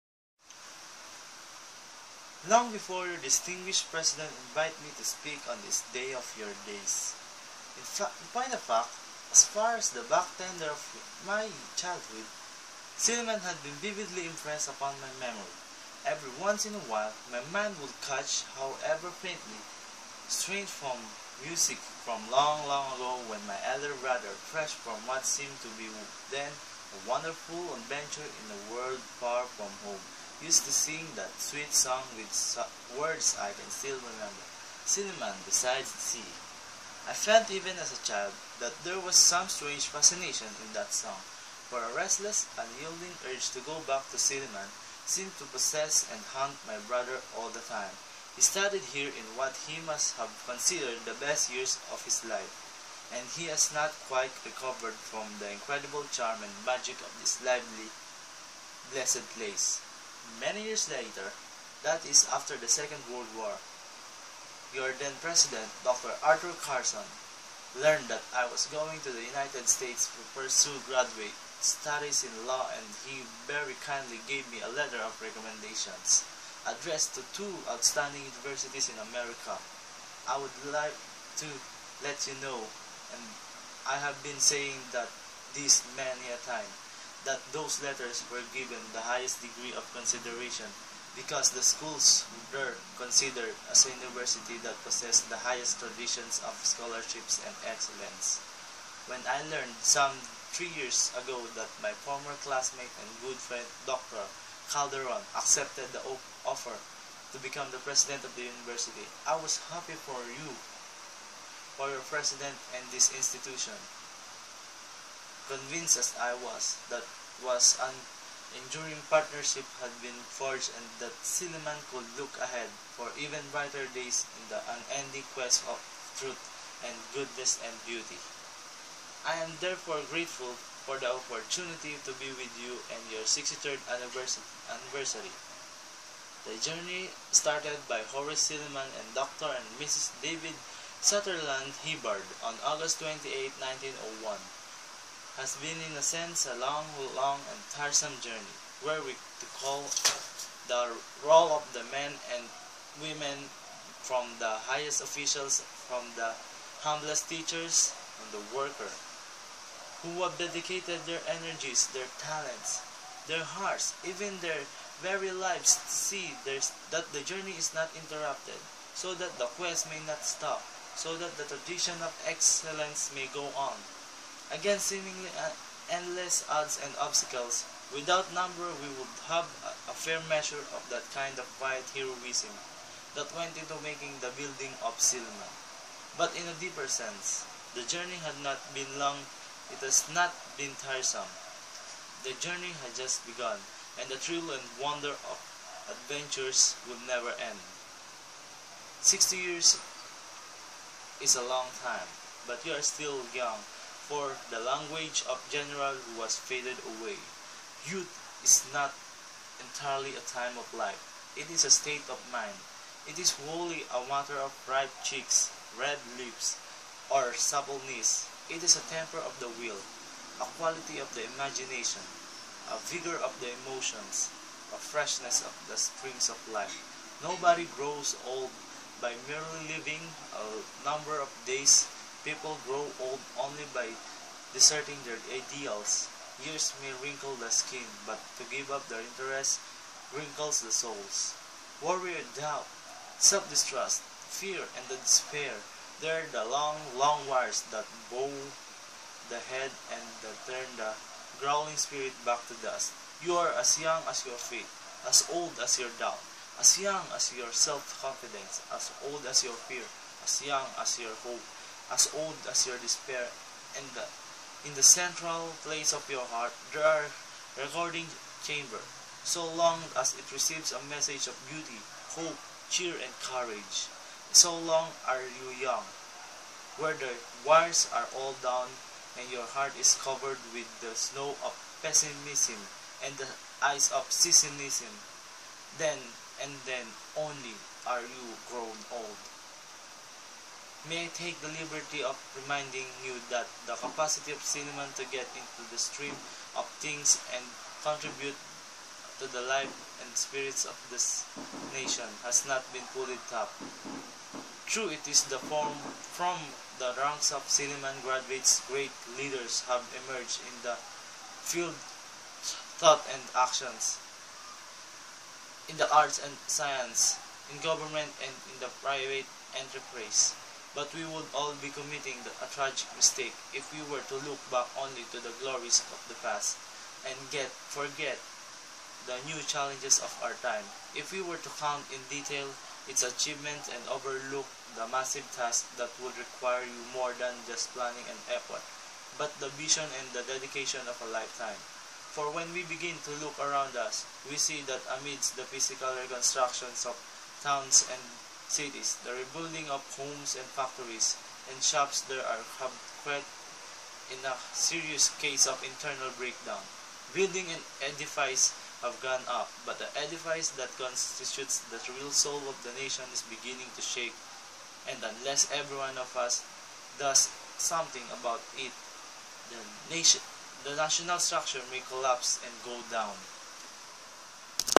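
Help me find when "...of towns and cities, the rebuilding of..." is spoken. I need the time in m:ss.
5:46.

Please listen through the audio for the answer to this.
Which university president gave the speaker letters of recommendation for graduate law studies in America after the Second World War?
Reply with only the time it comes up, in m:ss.
1:05.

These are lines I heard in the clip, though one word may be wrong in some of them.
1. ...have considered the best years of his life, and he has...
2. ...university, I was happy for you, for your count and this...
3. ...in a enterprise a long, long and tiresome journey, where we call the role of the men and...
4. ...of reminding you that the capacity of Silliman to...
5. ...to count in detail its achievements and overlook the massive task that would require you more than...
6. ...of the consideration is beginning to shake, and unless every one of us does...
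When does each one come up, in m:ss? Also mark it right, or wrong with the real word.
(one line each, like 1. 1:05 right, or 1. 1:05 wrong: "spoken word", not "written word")
1. 0:50 right
2. 1:48 wrong: "president", not "count"
3. 2:25 wrong: "sense", not "enterprise"
4. 4:52 right
5. 5:31 right
6. 6:02 wrong: "nation", not "consideration".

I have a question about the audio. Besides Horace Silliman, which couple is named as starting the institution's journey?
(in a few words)
Dr. and Mrs. David Sutherland Hibbard.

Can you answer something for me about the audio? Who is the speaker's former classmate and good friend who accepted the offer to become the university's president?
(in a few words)
Dr. Calderon.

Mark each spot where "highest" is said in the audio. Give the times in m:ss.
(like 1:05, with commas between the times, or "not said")
1:29, 1:35, 2:34.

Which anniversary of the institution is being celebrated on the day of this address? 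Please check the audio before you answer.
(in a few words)
63rd.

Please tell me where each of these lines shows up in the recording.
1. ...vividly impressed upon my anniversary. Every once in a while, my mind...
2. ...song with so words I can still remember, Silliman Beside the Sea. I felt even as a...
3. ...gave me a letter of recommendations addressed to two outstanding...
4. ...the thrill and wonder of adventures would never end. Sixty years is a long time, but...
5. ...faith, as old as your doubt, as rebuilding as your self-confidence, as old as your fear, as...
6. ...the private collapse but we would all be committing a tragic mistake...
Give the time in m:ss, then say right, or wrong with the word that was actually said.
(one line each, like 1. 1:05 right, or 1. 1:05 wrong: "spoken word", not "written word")
1. 0:13 wrong: "memory", not "anniversary"
2. 0:31 right
3. 1:14 right
4. 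3:14 right
5. 4:14 wrong: "young", not "rebuilding"
6. 5:18 wrong: "enterprise", not "collapse".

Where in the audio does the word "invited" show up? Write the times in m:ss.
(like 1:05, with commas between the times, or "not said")
0:04.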